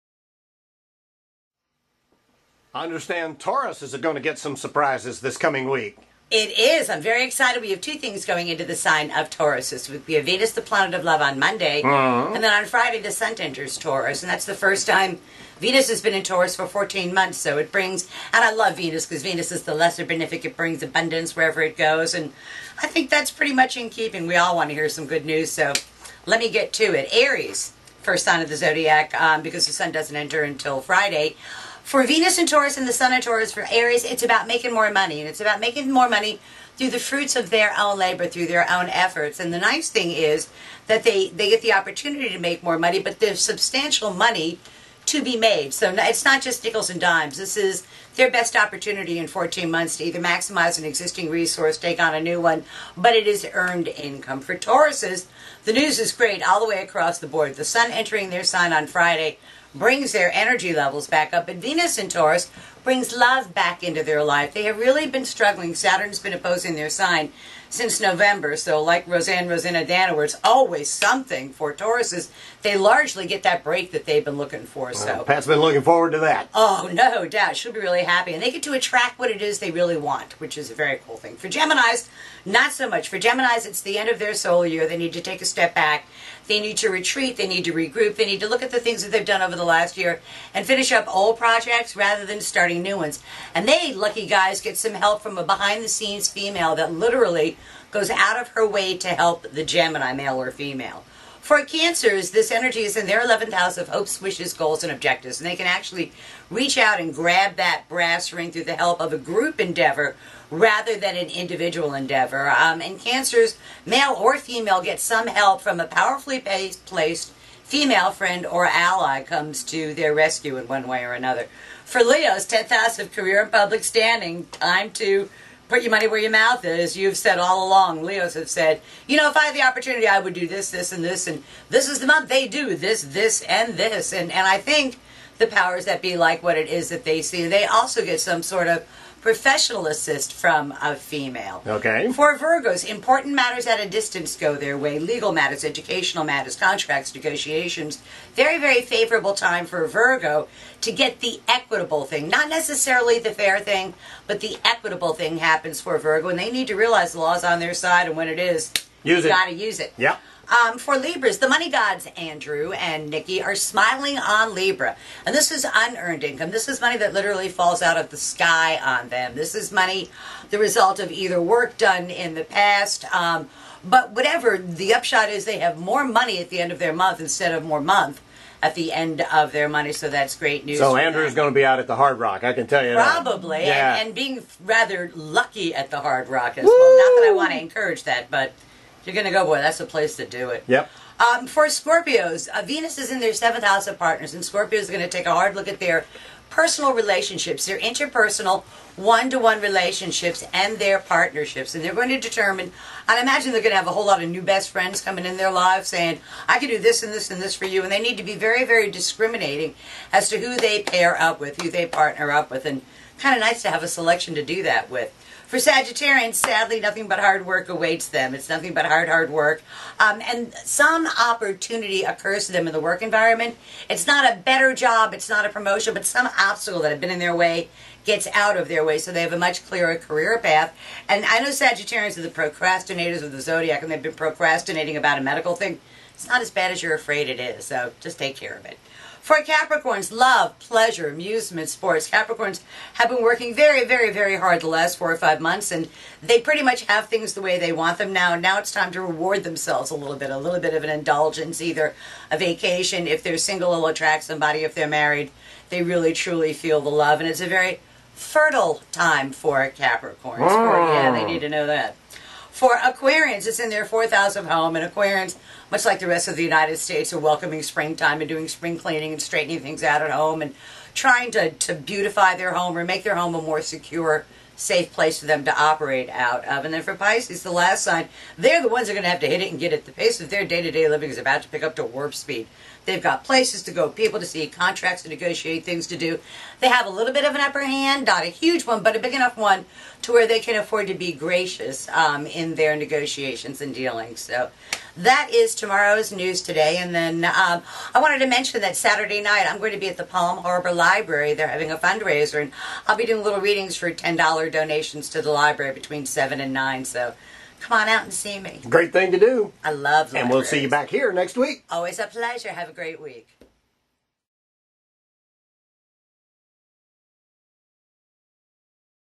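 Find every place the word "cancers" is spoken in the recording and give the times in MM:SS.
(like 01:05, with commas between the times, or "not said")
01:41, 01:52.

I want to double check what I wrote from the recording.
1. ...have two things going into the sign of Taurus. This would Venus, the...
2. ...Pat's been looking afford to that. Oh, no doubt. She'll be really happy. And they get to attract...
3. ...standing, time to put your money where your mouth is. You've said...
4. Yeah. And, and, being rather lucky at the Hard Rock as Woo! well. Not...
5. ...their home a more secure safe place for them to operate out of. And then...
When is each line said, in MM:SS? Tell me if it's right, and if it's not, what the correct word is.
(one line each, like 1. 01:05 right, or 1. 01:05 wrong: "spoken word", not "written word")
1. 00:07 right
2. 01:15 wrong: "forward", not "afford"
3. 02:03 right
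4. 03:03 right
5. 04:33 right.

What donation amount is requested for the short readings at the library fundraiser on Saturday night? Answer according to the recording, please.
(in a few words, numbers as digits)
$10.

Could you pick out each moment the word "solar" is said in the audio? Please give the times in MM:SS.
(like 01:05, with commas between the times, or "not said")
01:24.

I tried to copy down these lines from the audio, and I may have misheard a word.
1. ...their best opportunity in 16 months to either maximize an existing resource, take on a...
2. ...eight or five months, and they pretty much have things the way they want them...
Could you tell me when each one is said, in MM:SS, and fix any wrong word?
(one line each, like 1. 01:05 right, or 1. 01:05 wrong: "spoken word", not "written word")
1. 00:48 wrong: "14", not "16"
2. 04:04 wrong: "four", not "eight".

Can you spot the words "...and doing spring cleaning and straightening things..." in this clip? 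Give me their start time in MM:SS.
04:28.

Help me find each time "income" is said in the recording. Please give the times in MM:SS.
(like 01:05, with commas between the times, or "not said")
00:53, 02:46.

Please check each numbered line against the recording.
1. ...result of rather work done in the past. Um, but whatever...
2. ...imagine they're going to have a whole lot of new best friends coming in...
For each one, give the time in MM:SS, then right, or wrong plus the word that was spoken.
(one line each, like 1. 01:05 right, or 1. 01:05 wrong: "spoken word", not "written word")
1. 02:50 wrong: "either", not "rather"
2. 03:23 right.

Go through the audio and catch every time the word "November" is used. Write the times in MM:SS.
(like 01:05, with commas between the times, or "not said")
01:08.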